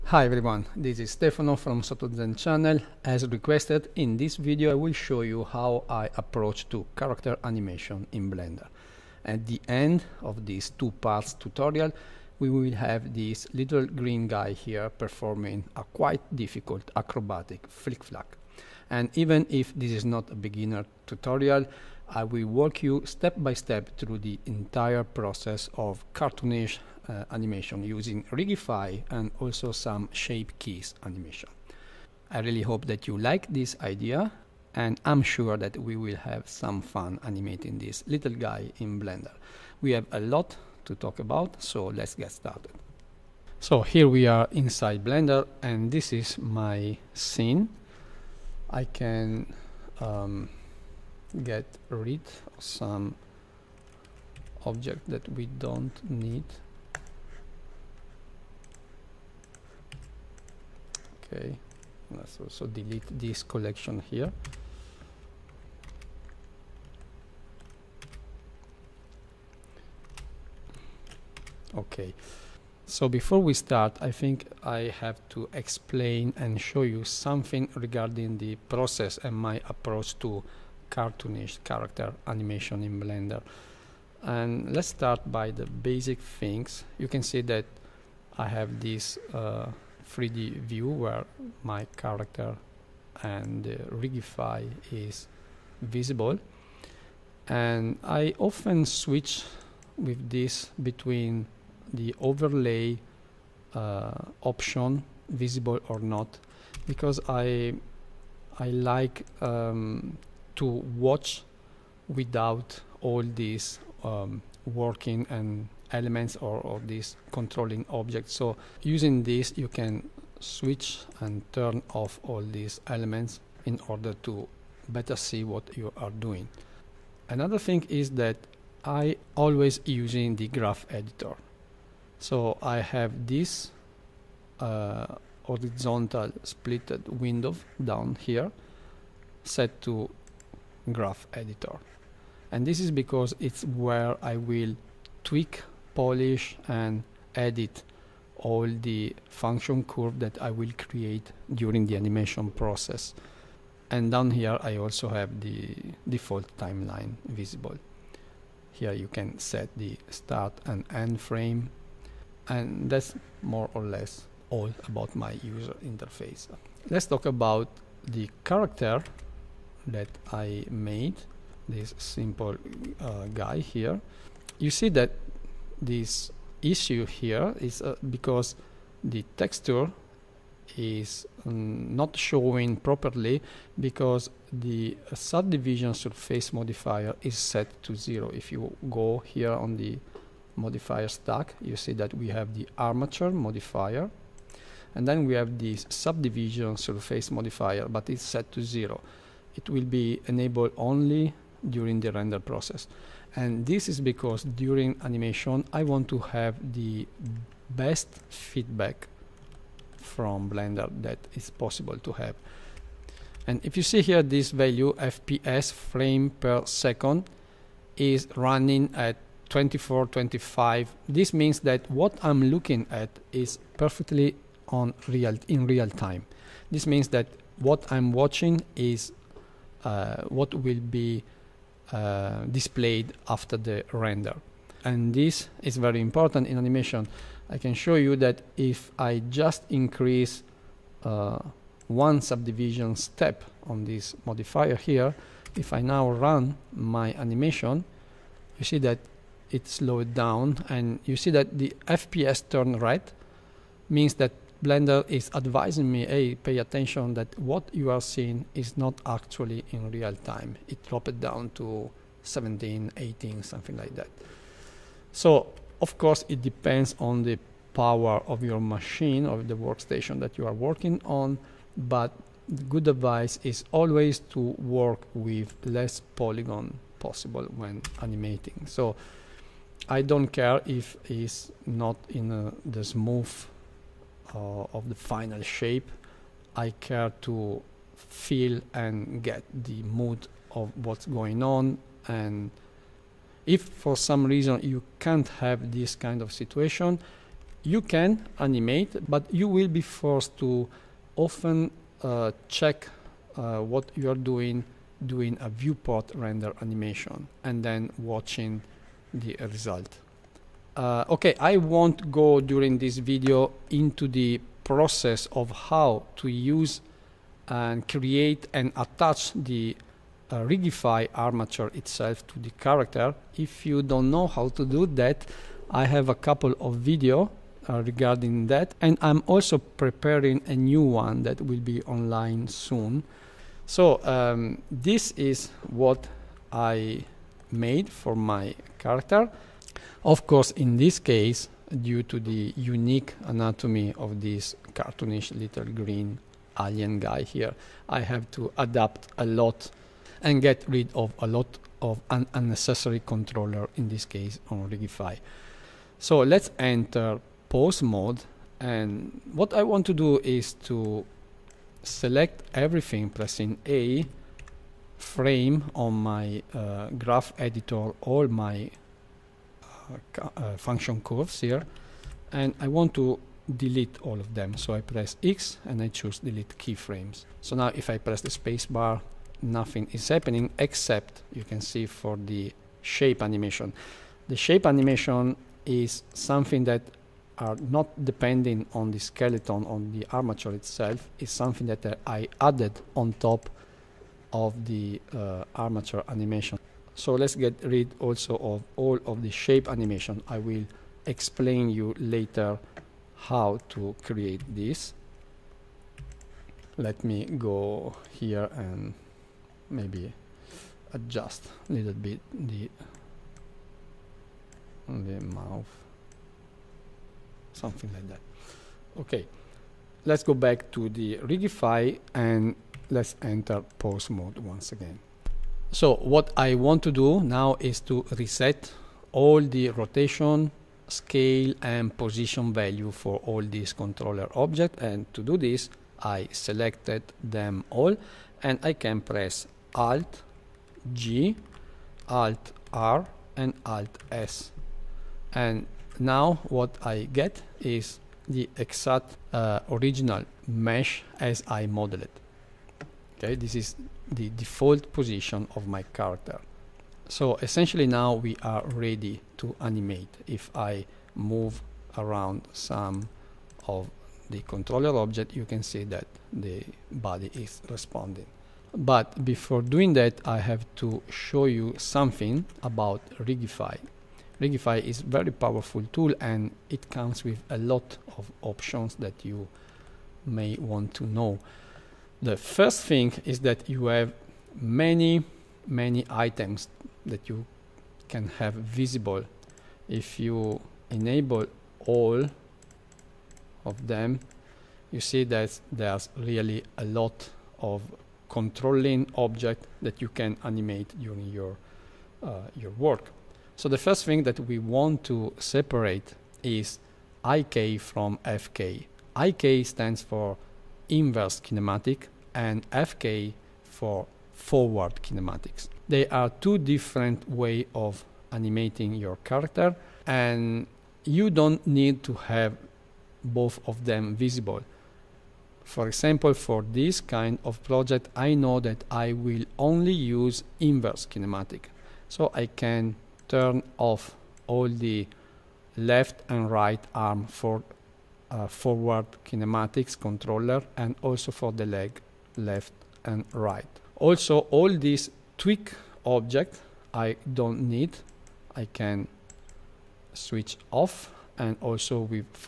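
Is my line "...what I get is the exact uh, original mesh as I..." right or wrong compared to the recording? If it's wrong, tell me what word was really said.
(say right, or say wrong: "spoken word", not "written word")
right.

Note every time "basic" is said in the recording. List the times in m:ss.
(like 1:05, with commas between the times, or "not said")
1:25.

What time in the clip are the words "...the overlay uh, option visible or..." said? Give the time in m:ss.
1:41.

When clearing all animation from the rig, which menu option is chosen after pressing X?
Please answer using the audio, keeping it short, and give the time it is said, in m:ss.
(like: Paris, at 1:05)
delete keyframes, at 6:16.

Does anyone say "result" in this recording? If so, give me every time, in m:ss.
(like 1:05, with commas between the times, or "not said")
5:09.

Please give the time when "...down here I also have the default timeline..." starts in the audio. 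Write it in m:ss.
2:34.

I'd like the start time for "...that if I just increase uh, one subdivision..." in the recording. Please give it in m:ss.
3:58.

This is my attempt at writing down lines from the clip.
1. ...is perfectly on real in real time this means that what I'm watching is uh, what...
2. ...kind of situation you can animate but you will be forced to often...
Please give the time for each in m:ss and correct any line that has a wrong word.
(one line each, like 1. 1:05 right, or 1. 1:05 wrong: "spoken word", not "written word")
1. 3:43 right
2. 4:55 right.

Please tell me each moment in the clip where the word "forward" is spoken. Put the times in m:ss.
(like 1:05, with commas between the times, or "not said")
8:34, 8:58.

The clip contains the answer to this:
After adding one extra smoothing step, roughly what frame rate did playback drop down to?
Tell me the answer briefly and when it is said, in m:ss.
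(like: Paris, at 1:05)
17 to 18, at 4:22.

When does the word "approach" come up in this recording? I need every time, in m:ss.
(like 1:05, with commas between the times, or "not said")
0:06, 1:19.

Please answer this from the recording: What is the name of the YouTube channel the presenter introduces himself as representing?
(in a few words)
SottoZen.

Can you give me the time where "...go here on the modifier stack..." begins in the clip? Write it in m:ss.
3:08.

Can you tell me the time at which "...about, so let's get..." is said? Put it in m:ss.
0:41.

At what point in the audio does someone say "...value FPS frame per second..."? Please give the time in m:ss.
3:34.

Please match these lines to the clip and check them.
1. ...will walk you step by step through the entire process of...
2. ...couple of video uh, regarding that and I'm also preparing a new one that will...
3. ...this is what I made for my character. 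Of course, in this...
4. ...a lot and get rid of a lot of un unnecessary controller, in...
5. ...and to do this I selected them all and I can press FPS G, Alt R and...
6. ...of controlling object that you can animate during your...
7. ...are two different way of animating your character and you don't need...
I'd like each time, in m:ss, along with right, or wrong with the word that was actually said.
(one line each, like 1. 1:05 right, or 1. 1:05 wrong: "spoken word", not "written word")
1. 0:22 right
2. 5:26 right
3. 5:34 right
4. 5:49 right
5. 7:14 wrong: "Alt", not "FPS"
6. 8:17 right
7. 8:36 right.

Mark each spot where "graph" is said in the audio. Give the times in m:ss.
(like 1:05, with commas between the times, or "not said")
2:10, 2:20, 6:06.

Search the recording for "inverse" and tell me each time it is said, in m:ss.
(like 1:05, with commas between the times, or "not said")
8:30, 8:50.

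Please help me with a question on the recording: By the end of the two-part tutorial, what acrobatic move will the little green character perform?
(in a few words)
flick-flack.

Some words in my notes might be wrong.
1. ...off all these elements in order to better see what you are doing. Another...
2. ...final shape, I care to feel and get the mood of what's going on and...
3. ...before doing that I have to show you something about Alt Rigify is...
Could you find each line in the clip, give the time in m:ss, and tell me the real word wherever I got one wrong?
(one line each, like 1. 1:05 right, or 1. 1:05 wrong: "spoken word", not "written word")
1. 2:01 right
2. 4:44 right
3. 7:49 wrong: "Rigify", not "Alt".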